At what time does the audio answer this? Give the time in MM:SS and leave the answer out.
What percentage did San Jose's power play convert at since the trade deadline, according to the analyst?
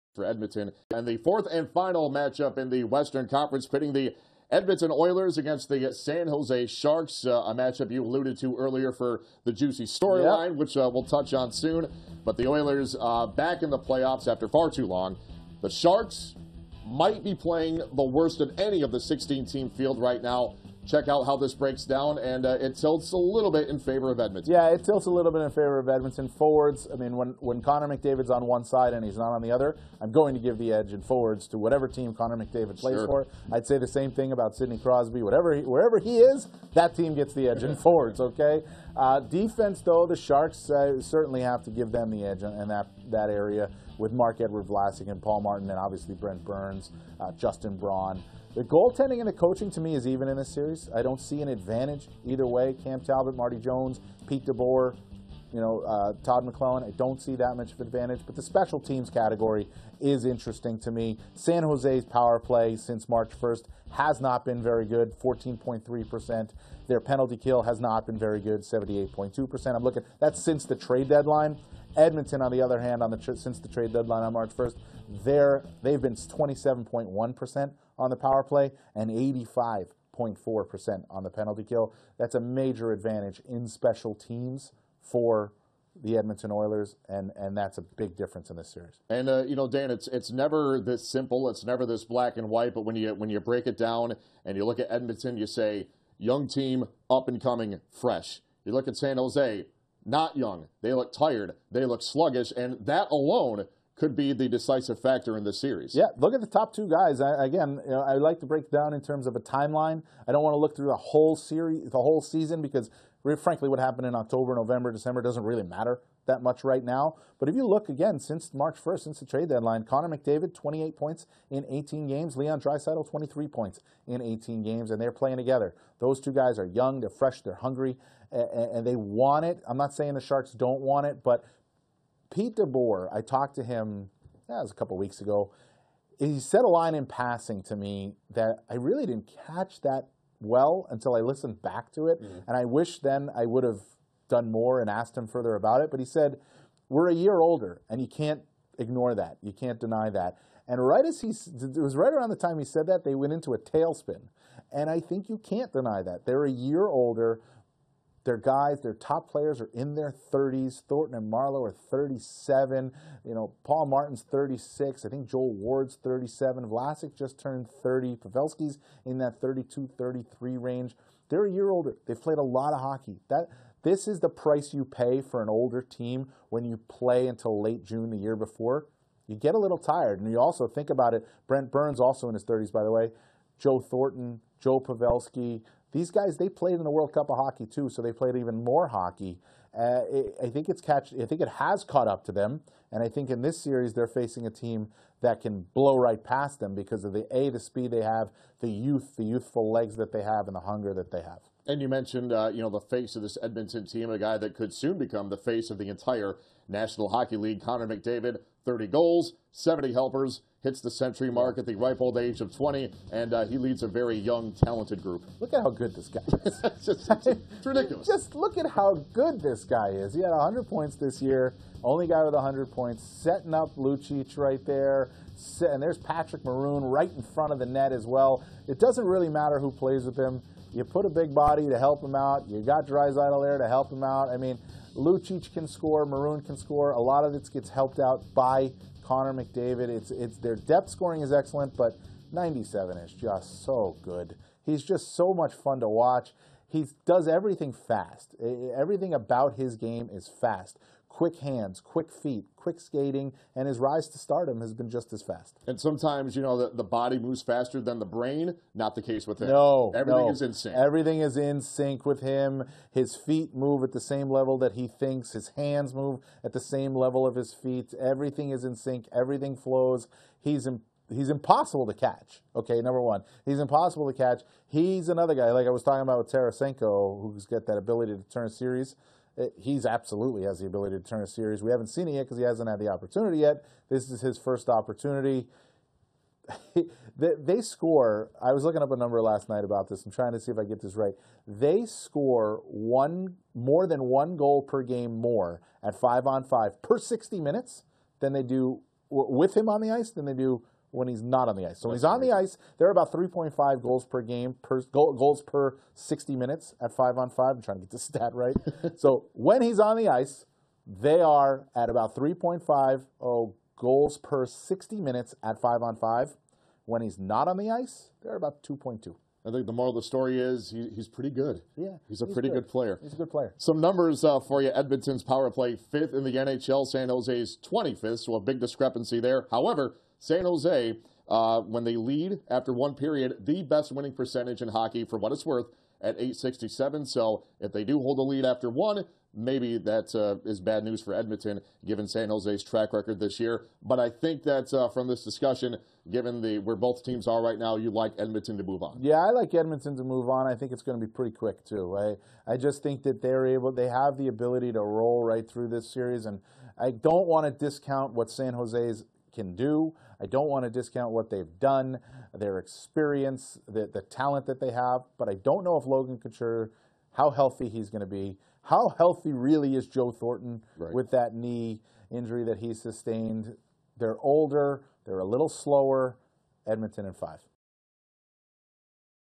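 01:05.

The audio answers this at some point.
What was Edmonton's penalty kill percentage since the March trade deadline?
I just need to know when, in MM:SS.
01:19.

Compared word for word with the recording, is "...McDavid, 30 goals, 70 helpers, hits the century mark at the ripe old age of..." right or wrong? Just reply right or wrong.
right.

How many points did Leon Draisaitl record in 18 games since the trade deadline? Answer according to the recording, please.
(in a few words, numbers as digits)
23.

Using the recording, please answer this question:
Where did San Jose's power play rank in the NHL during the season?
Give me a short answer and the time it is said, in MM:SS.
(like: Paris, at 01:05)
25th, at 05:27.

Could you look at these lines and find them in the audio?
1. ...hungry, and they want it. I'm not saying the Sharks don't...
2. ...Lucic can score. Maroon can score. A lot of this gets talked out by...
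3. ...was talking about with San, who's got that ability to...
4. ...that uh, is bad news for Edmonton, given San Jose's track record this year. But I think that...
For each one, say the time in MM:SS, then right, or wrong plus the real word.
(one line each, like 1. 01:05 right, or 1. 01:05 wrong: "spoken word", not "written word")
1. 02:07 right
2. 03:54 wrong: "helped", not "talked"
3. 04:35 wrong: "Tarasenko", not "San"
4. 05:39 right.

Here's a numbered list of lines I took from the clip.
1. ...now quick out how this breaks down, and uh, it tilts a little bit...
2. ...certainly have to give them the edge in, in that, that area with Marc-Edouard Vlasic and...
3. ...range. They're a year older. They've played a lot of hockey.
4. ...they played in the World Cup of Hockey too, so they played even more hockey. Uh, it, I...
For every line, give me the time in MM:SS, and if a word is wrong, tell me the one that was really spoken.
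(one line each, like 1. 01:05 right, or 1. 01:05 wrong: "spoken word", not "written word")
1. 00:20 wrong: "check", not "quick"
2. 00:41 right
3. 02:50 right
4. 03:06 right.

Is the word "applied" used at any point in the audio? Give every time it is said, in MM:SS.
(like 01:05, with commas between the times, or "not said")
not said.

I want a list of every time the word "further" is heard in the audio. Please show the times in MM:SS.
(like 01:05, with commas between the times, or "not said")
02:25.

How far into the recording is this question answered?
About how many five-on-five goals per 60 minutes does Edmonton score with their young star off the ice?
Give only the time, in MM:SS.
05:18.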